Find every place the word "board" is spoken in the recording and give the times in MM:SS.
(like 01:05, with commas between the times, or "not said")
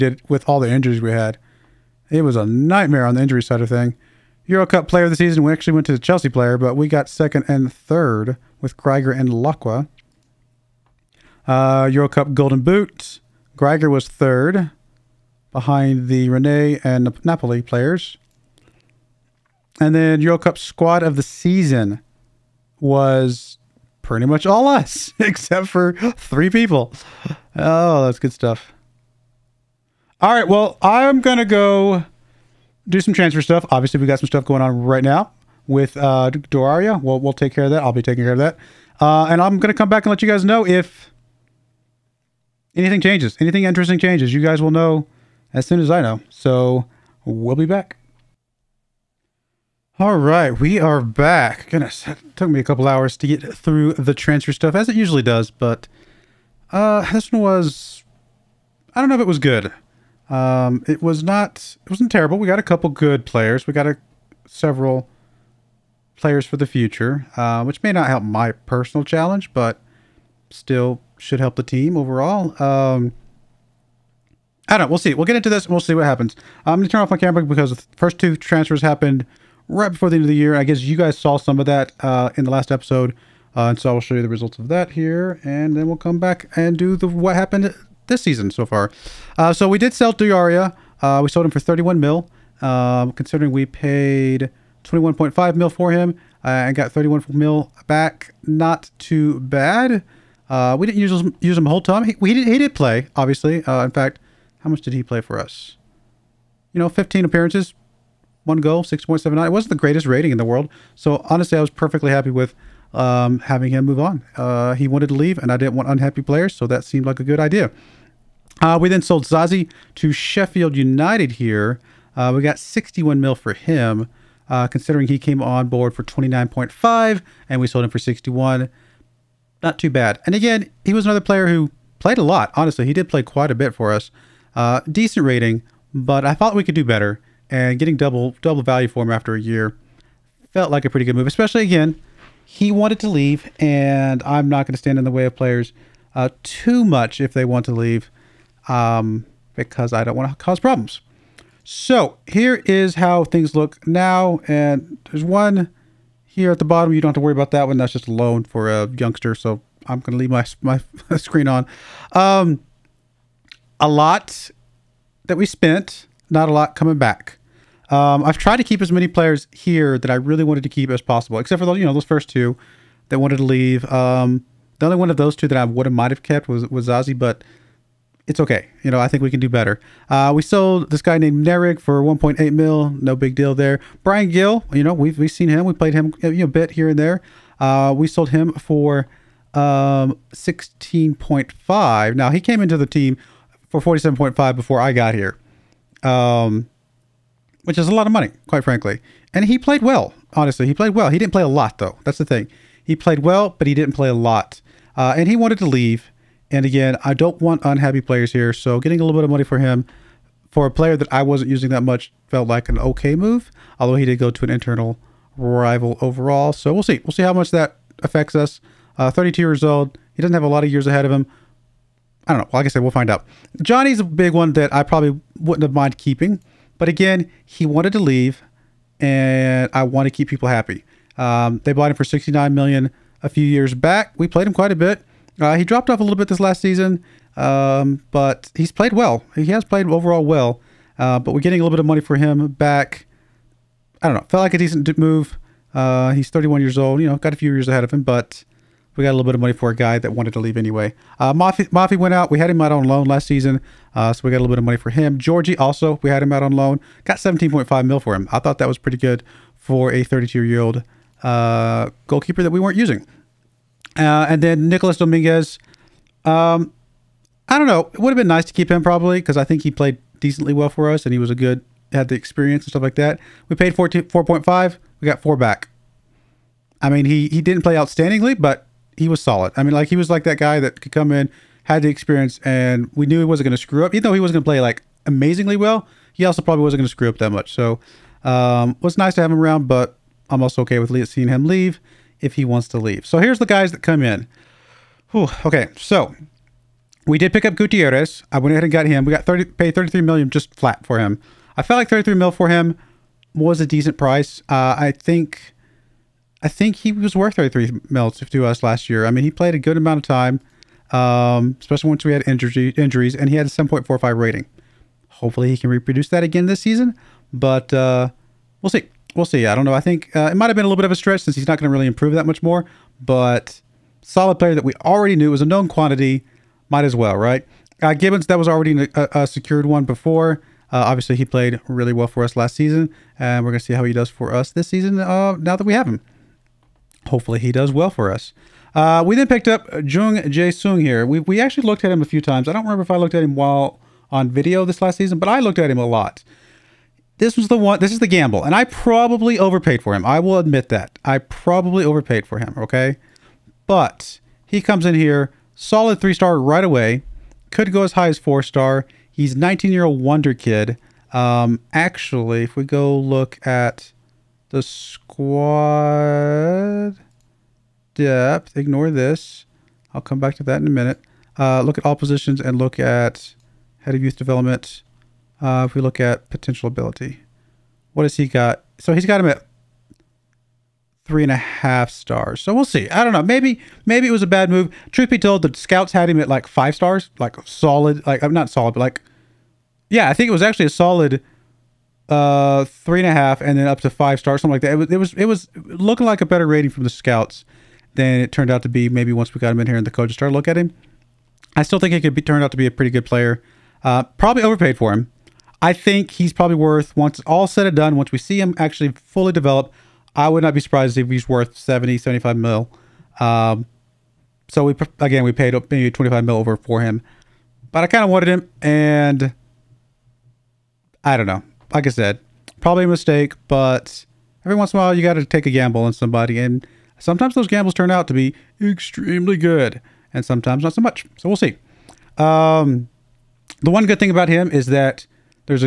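02:05.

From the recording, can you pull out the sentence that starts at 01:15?
We'll get into this and we'll see what happens.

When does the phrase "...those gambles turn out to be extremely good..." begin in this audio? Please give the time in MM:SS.
07:07.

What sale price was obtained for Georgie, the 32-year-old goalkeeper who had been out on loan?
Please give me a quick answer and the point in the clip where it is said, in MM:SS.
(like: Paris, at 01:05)
17.5 million, at 04:17.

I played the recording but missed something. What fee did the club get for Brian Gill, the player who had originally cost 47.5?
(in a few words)
16.5 million.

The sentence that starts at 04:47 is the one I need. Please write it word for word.
So um, it was nice to have him around, but I'm also okay with seeing him leave if he wants to leave.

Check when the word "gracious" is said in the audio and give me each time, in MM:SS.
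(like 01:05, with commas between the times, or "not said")
not said.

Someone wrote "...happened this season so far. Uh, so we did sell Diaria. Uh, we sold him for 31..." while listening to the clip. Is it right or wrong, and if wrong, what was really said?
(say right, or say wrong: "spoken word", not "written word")
right.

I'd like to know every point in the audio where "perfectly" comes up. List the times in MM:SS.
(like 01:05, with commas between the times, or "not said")
01:51.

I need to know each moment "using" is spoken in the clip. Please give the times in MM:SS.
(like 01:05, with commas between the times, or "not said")
03:31, 04:22.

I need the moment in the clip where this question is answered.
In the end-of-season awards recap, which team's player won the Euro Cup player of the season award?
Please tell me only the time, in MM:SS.
00:05.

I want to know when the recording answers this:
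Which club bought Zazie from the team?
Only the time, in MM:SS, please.
02:00.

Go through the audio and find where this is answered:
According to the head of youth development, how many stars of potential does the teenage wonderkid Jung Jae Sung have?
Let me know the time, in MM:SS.
06:21.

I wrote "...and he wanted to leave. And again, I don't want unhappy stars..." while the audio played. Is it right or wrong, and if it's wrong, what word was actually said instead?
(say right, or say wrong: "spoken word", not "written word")
wrong: "players", not "stars".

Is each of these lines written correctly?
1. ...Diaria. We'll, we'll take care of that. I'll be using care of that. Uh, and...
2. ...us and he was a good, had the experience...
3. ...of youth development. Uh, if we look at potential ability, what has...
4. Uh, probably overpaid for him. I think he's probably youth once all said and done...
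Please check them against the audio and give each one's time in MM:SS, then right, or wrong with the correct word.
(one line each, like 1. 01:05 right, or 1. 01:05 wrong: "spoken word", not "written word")
1. 00:36 wrong: "taking", not "using"
2. 04:30 right
3. 06:13 right
4. 06:43 wrong: "worth", not "youth".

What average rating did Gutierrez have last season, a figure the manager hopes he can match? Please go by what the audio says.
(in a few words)
7.45.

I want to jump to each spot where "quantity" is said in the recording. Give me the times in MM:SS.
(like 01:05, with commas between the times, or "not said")
05:25.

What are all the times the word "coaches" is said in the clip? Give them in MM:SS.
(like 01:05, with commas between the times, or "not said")
06:39.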